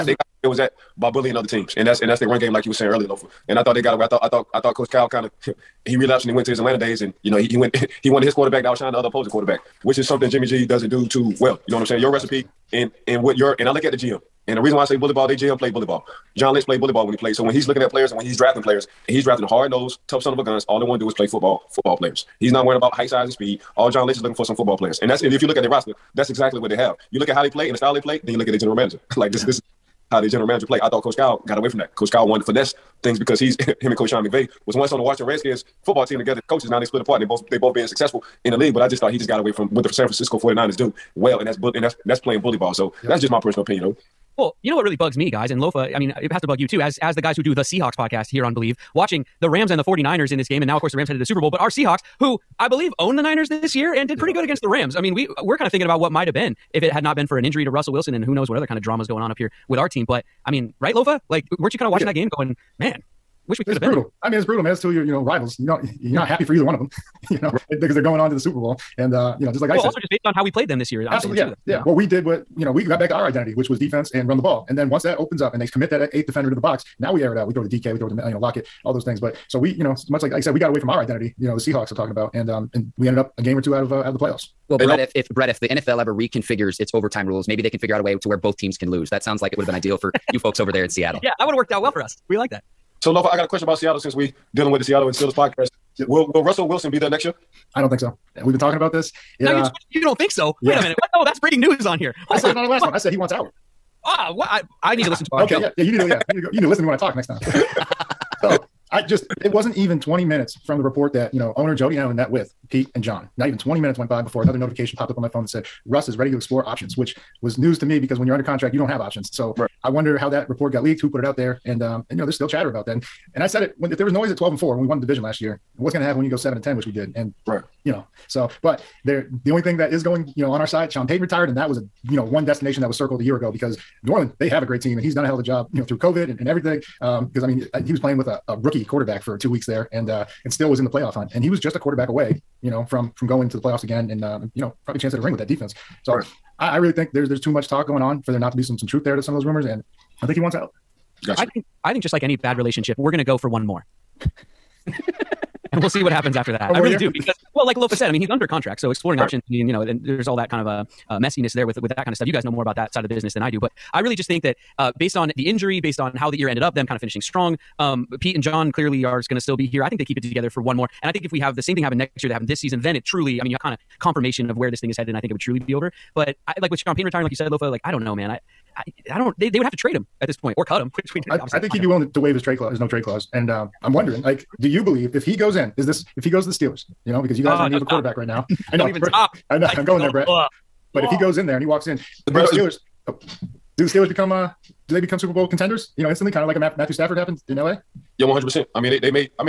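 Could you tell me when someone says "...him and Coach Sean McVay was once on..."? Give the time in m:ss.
0:33.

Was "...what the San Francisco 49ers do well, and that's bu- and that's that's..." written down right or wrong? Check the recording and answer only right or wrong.
right.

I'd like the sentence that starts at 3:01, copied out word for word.
I think he'd be willing to, to, waive his trade clause, his no trade clause.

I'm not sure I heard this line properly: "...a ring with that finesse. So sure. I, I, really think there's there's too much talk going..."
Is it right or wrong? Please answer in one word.
wrong.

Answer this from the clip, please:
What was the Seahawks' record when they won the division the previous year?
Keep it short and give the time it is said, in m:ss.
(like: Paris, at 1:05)
12 and 4, at 2:04.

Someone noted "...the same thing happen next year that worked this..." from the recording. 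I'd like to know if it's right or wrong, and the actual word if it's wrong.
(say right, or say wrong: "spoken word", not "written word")
wrong: "happened", not "worked".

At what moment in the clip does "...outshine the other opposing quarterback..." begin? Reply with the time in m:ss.
0:08.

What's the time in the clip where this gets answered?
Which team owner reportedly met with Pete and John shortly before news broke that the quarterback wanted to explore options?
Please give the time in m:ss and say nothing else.
1:51.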